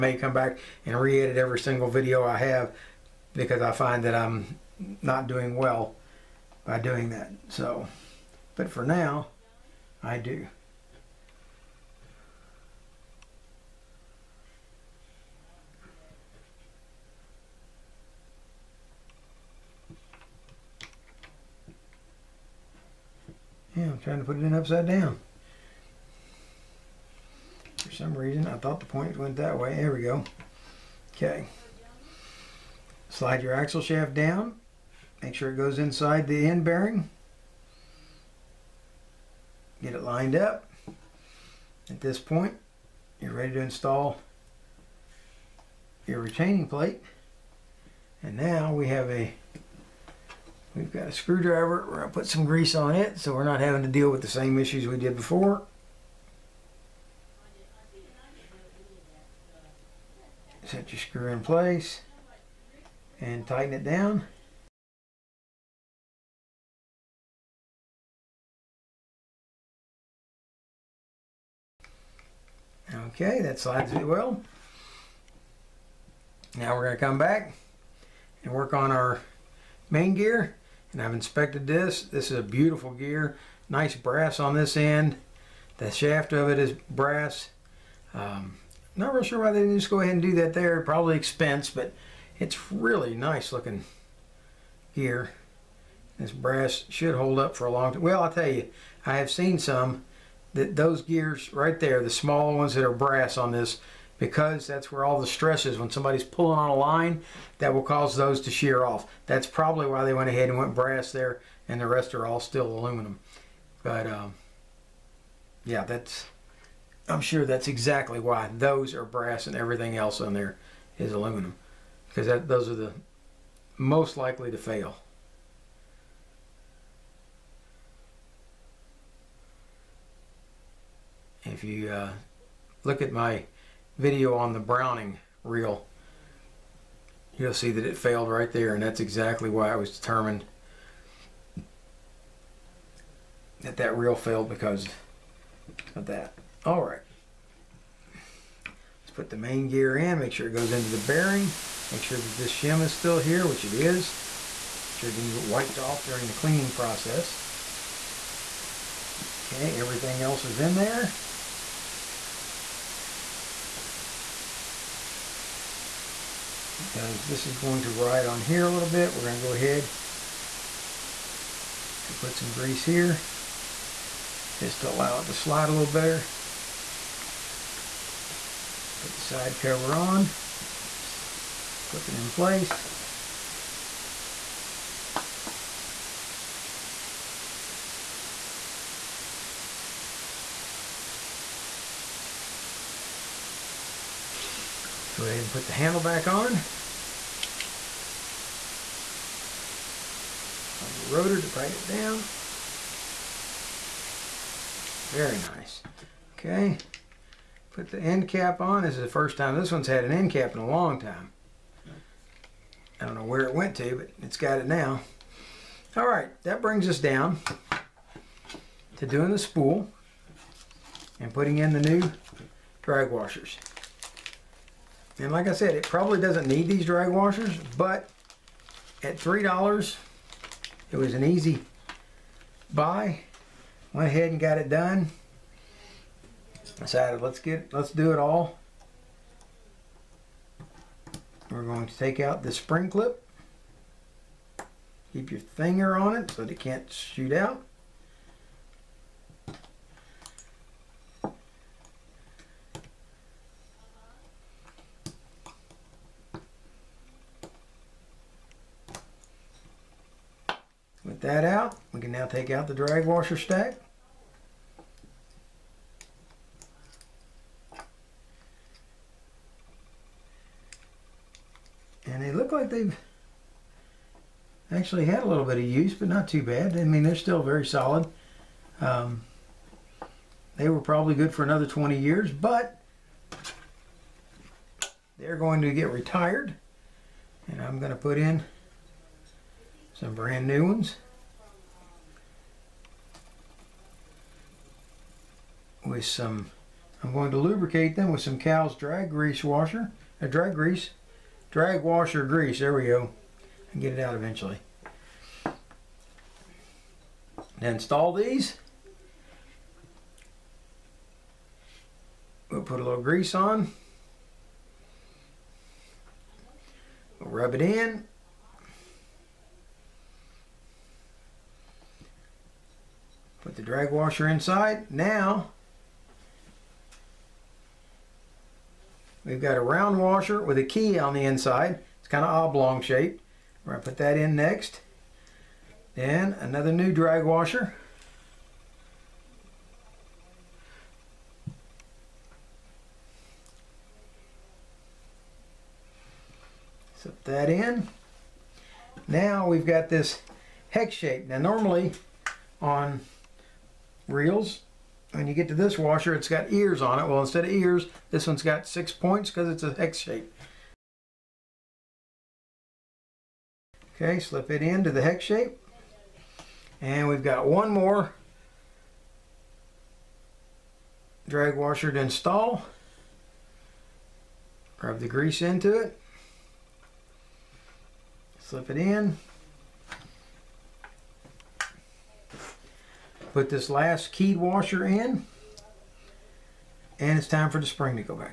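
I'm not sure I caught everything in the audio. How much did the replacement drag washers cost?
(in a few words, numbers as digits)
$3.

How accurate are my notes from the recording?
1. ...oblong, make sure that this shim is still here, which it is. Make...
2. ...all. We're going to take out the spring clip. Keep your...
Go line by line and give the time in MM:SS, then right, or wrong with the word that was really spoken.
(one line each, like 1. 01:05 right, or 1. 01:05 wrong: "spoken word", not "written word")
1. 02:30 wrong: "bearing", not "oblong"
2. 03:58 right.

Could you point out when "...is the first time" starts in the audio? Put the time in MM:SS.
03:28.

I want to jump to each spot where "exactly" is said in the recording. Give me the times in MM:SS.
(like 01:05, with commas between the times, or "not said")
01:57, 02:18.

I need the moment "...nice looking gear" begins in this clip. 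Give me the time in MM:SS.
01:33.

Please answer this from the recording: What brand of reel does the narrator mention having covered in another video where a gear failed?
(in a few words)
Browning.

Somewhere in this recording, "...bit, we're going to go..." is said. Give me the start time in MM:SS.
02:48.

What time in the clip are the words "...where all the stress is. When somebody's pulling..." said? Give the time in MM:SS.
01:44.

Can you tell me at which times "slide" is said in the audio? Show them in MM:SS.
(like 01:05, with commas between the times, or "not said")
00:33, 01:13, 02:55.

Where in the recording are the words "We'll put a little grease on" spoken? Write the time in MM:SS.
05:12.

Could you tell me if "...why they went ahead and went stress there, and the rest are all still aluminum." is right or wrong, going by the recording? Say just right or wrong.
wrong.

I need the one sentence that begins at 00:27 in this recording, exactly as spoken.
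For some reason, I thought the point went that way.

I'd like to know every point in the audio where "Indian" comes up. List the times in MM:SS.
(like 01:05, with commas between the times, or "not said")
not said.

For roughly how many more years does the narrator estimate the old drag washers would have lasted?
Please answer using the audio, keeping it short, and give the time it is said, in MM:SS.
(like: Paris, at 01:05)
20, at 04:41.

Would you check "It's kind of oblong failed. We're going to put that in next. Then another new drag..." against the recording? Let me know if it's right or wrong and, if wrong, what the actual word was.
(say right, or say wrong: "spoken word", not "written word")
wrong: "shaped", not "failed".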